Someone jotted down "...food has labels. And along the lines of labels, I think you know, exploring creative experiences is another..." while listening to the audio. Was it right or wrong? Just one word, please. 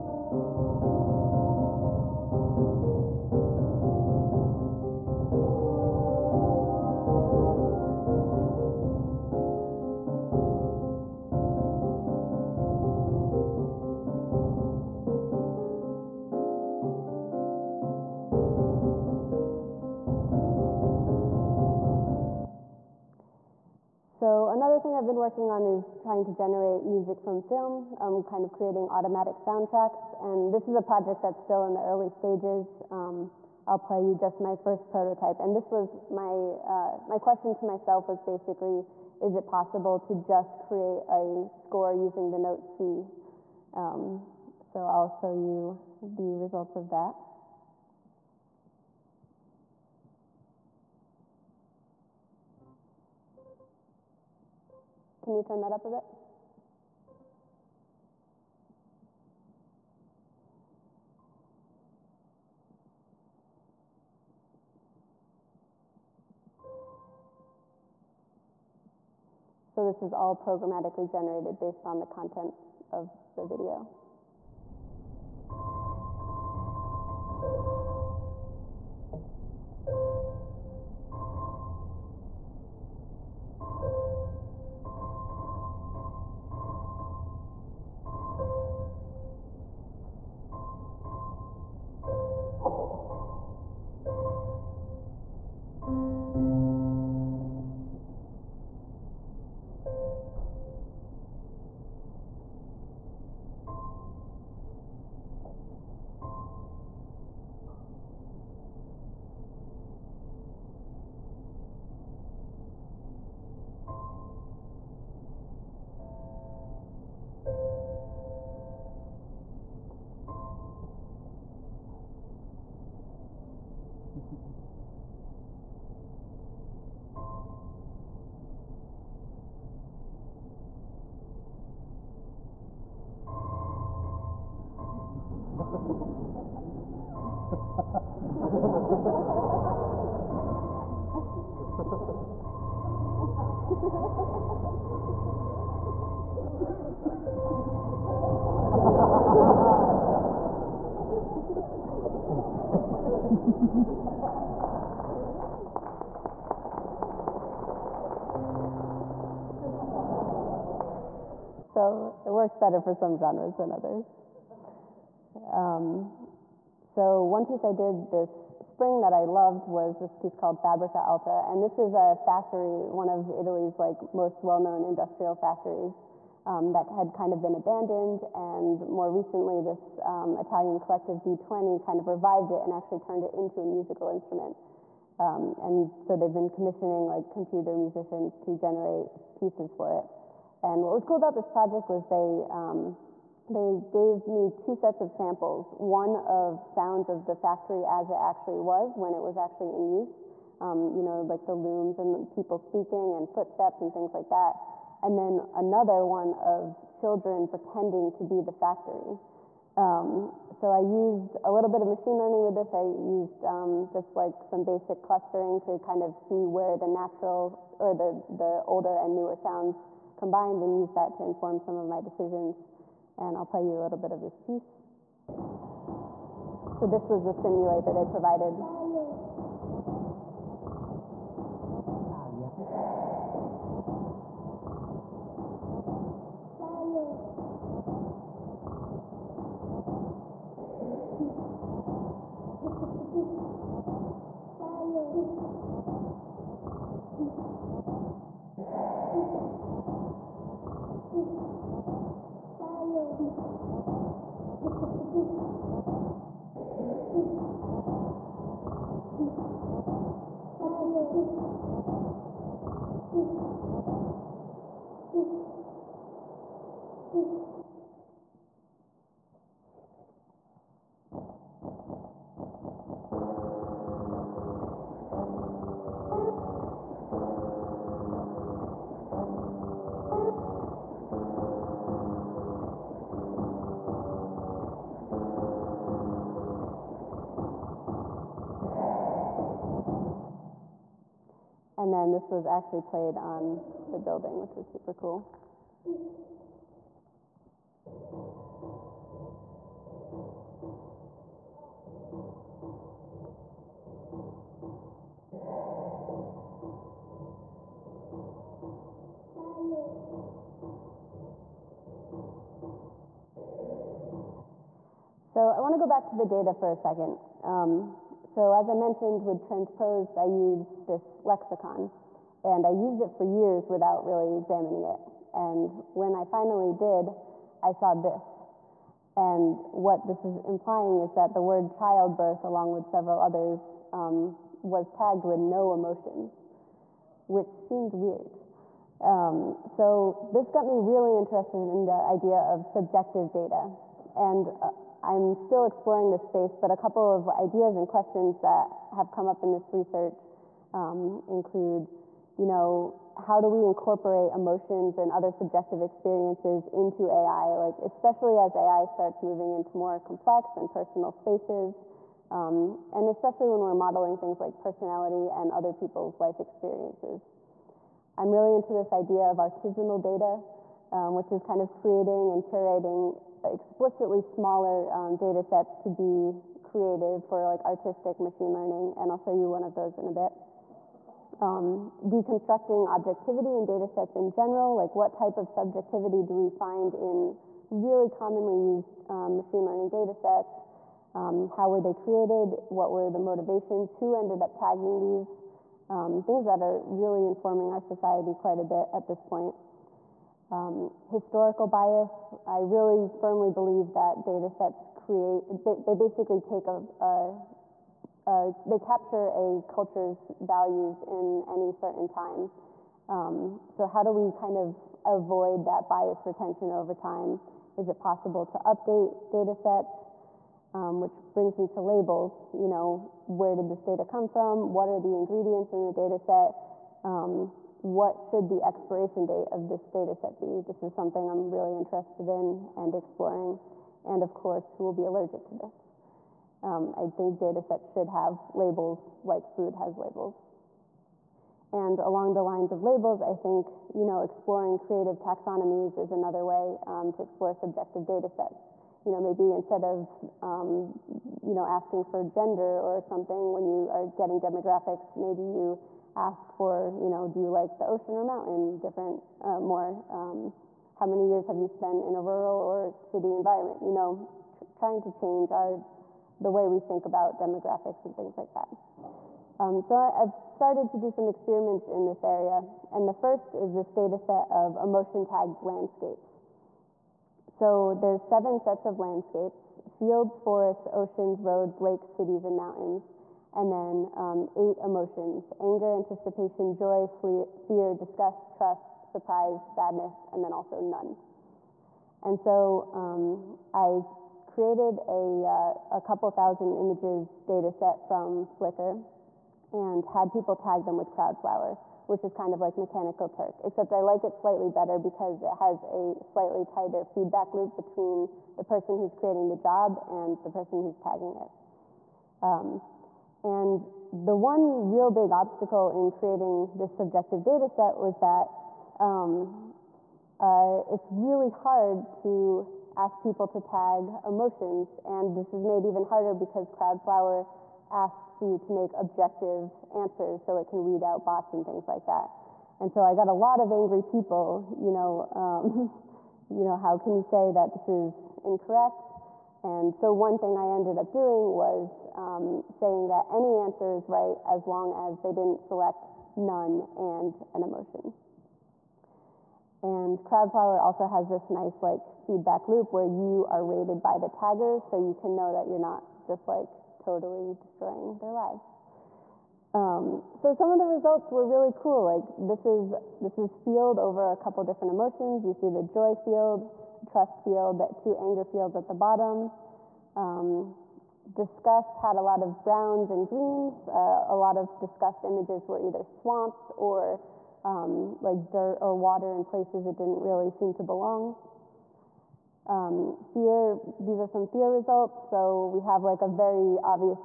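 wrong.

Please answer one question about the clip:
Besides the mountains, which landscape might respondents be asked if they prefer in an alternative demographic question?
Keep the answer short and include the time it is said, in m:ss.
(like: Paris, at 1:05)
the ocean, at 7:37.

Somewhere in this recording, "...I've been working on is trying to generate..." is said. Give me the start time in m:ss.
0:24.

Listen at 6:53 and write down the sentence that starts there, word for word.
Um, so how do we kind of avoid that bias retention over time?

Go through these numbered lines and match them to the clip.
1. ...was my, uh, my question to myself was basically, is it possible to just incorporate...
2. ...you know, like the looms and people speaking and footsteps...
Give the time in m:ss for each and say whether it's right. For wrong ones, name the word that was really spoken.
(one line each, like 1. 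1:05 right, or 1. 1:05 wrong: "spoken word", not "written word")
1. 0:35 wrong: "create", not "incorporate"
2. 3:20 right.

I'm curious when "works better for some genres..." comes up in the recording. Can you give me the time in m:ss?
2:42.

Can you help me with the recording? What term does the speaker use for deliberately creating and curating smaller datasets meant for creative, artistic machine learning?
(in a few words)
artisanal data.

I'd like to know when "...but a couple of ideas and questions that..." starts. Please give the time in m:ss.
5:46.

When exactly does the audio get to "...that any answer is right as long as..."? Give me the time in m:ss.
9:03.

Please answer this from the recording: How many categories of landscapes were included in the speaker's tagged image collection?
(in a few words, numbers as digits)
7.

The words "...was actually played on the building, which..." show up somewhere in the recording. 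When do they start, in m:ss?
4:52.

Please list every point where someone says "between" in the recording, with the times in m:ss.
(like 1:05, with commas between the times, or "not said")
8:27.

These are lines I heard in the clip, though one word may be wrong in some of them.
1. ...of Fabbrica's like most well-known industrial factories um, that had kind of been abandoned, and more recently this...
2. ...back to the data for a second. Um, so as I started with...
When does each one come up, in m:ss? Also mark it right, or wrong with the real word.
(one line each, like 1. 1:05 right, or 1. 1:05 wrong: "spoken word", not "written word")
1. 2:53 wrong: "Italy", not "Fabbrica"
2. 5:15 wrong: "mentioned", not "started".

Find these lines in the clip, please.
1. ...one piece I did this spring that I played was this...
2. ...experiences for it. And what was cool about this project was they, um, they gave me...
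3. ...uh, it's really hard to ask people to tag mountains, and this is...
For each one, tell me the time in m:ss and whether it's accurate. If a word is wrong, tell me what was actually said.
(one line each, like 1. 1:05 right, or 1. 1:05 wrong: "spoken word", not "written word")
1. 2:47 wrong: "loved", not "played"
2. 3:09 wrong: "pieces", not "experiences"
3. 8:40 wrong: "emotions", not "mountains".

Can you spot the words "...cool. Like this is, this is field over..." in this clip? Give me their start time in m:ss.
9:21.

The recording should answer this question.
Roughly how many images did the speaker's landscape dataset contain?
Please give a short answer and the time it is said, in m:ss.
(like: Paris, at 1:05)
a couple thousand, at 8:15.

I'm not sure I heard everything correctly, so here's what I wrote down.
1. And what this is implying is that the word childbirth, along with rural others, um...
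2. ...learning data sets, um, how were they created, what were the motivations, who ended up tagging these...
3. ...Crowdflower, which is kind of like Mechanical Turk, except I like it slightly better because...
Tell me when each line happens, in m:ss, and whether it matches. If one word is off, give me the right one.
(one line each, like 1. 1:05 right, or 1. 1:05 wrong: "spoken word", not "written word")
1. 5:29 wrong: "several", not "rural"
2. 6:29 right
3. 8:21 right.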